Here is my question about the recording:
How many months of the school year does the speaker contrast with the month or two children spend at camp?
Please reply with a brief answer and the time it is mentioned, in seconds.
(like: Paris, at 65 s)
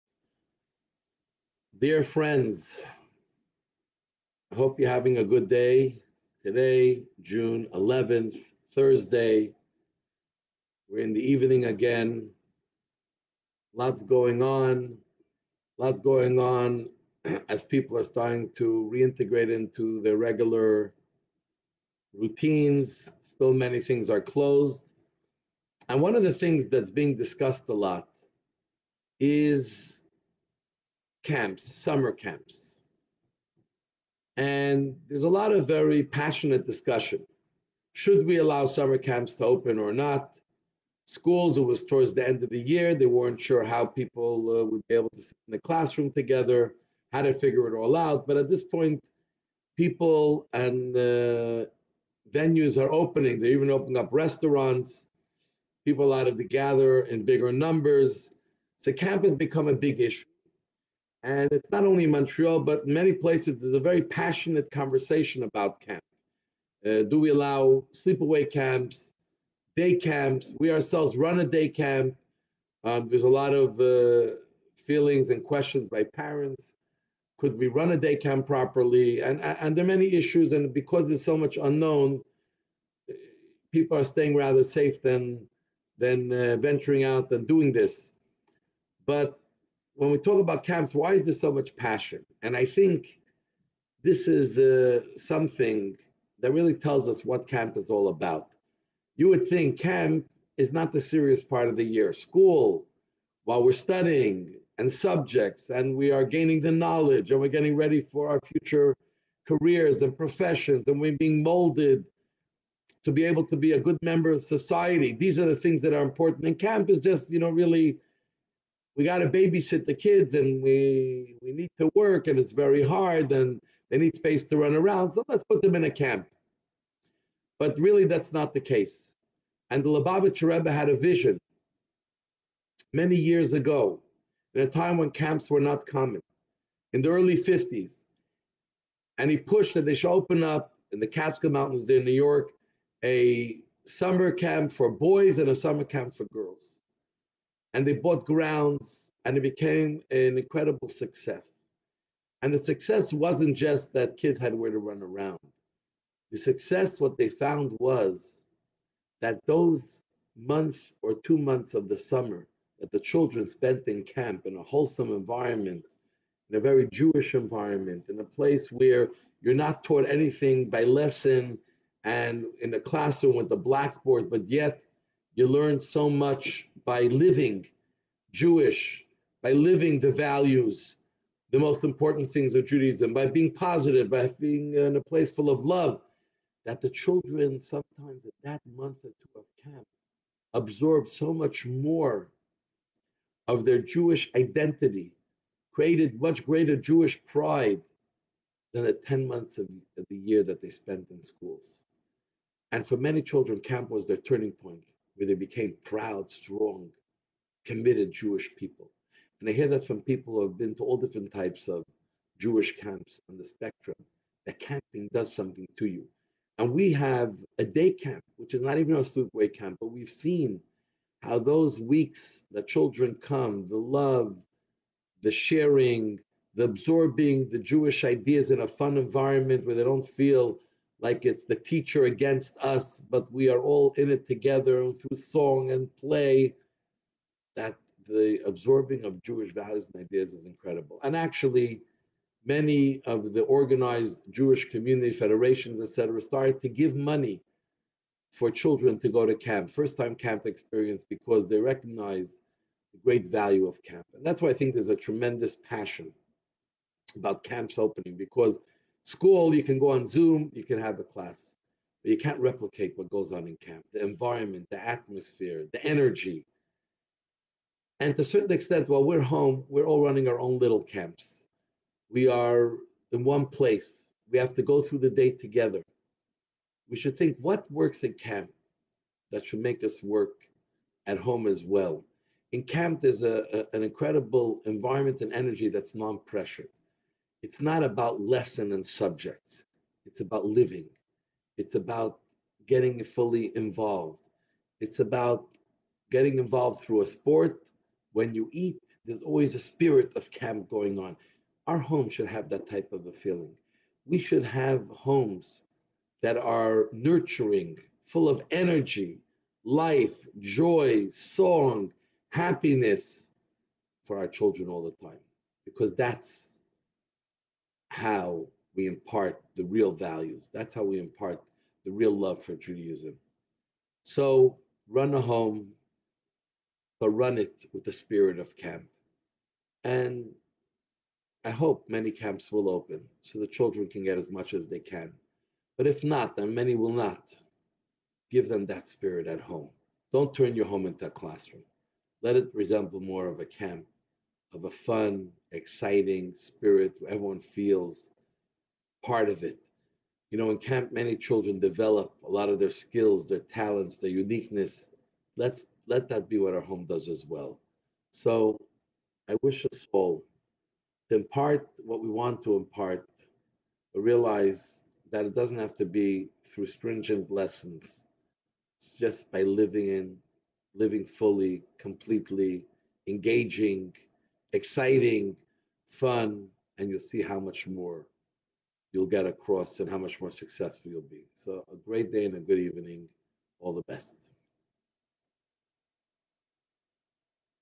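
10, at 198 s.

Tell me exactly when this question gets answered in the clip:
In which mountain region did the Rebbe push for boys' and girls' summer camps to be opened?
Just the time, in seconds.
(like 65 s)
141 s.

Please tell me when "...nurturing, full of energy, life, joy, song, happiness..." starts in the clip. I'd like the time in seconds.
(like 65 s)
306 s.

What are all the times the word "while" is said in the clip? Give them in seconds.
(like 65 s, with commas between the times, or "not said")
103 s, 268 s.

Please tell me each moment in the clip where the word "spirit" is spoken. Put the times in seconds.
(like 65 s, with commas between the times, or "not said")
299 s, 327 s, 338 s, 346 s.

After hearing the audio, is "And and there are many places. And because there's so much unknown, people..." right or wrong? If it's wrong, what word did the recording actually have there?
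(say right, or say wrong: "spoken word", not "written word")
wrong: "issues", not "places".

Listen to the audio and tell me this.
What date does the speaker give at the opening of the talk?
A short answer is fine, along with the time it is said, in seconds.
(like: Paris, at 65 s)
June 11th, at 7 s.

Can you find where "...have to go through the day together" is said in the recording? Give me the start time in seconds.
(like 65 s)
274 s.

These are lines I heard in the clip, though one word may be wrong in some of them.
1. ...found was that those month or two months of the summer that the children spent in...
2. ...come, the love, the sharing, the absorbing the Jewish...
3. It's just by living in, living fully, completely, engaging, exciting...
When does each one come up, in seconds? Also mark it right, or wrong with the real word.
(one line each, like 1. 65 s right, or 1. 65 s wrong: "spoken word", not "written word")
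1. 157 s right
2. 223 s right
3. 368 s right.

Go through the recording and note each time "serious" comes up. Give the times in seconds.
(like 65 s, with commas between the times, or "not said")
100 s.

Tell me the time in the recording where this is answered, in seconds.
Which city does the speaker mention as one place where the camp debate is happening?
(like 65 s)
62 s.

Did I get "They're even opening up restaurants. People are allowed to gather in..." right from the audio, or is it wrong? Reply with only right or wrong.
right.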